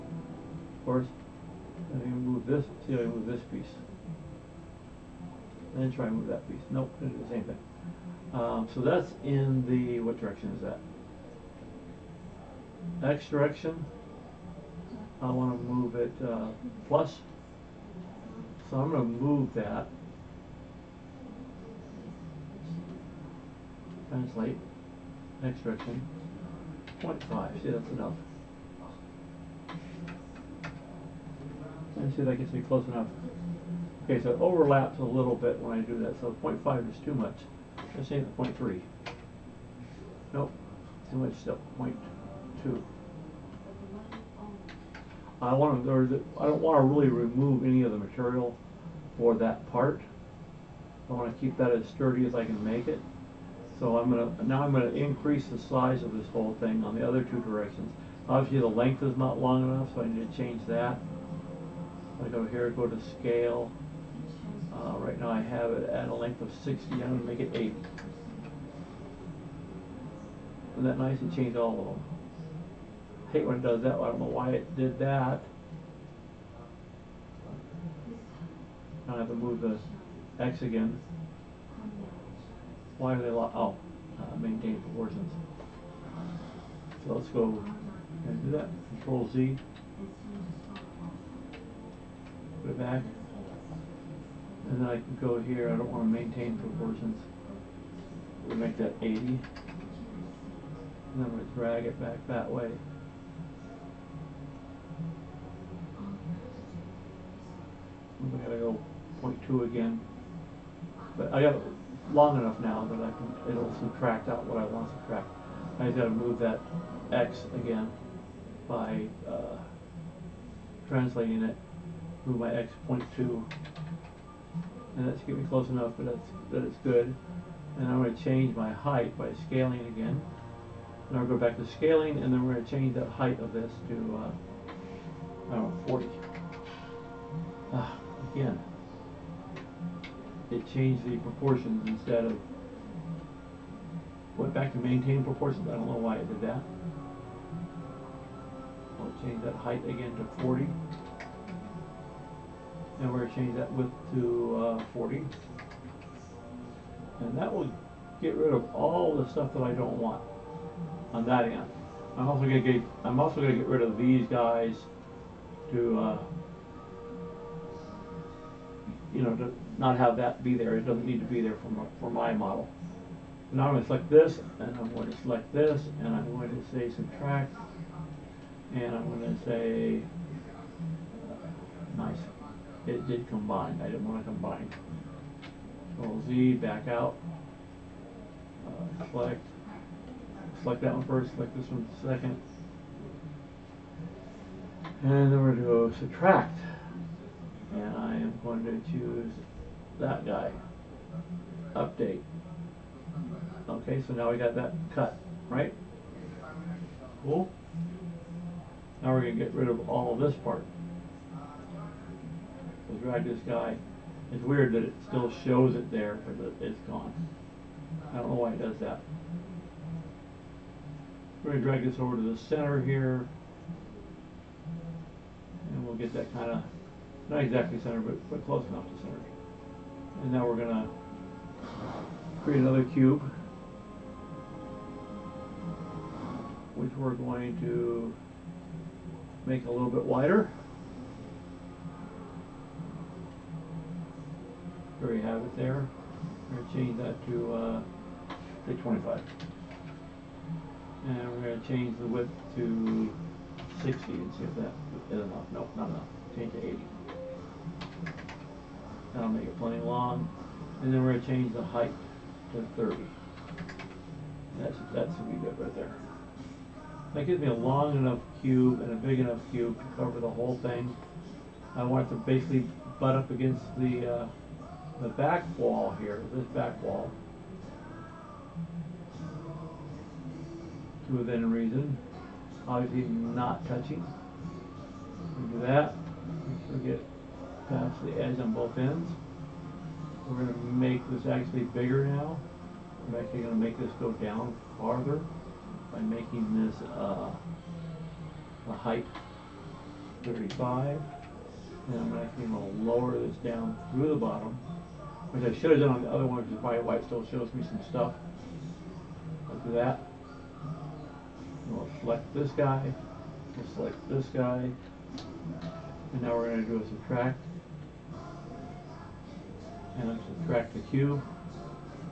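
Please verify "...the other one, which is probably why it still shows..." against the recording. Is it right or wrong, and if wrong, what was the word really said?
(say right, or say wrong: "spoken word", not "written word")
right.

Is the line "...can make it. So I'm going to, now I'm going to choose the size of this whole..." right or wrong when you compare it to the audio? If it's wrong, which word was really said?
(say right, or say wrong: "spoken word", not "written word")
wrong: "increase", not "choose".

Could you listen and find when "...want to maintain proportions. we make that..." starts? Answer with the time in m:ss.
1:35.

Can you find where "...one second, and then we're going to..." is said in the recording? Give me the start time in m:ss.
3:11.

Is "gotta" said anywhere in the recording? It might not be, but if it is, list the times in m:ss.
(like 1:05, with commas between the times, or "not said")
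1:48, 1:55.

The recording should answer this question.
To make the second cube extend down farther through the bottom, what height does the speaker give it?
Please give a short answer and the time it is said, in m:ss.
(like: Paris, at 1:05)
35, at 5:00.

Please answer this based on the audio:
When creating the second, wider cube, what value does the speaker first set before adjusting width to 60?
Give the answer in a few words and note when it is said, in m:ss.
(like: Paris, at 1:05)
25, at 4:08.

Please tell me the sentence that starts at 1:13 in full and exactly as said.
I hate when it does that, I don't know why it did that.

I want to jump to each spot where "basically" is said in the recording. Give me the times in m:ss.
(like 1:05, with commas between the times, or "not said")
4:32.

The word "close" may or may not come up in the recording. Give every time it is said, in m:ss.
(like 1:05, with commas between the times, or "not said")
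0:32, 2:05, 3:48.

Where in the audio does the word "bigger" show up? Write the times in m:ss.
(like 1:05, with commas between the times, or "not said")
4:51.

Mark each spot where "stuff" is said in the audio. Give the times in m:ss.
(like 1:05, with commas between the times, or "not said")
2:39, 5:07.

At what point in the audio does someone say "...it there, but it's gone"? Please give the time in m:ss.
3:35.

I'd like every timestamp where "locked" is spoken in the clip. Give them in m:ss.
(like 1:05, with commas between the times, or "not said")
1:23.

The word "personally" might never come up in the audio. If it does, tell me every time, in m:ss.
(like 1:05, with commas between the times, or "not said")
not said.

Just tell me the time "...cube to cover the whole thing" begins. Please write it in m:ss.
4:29.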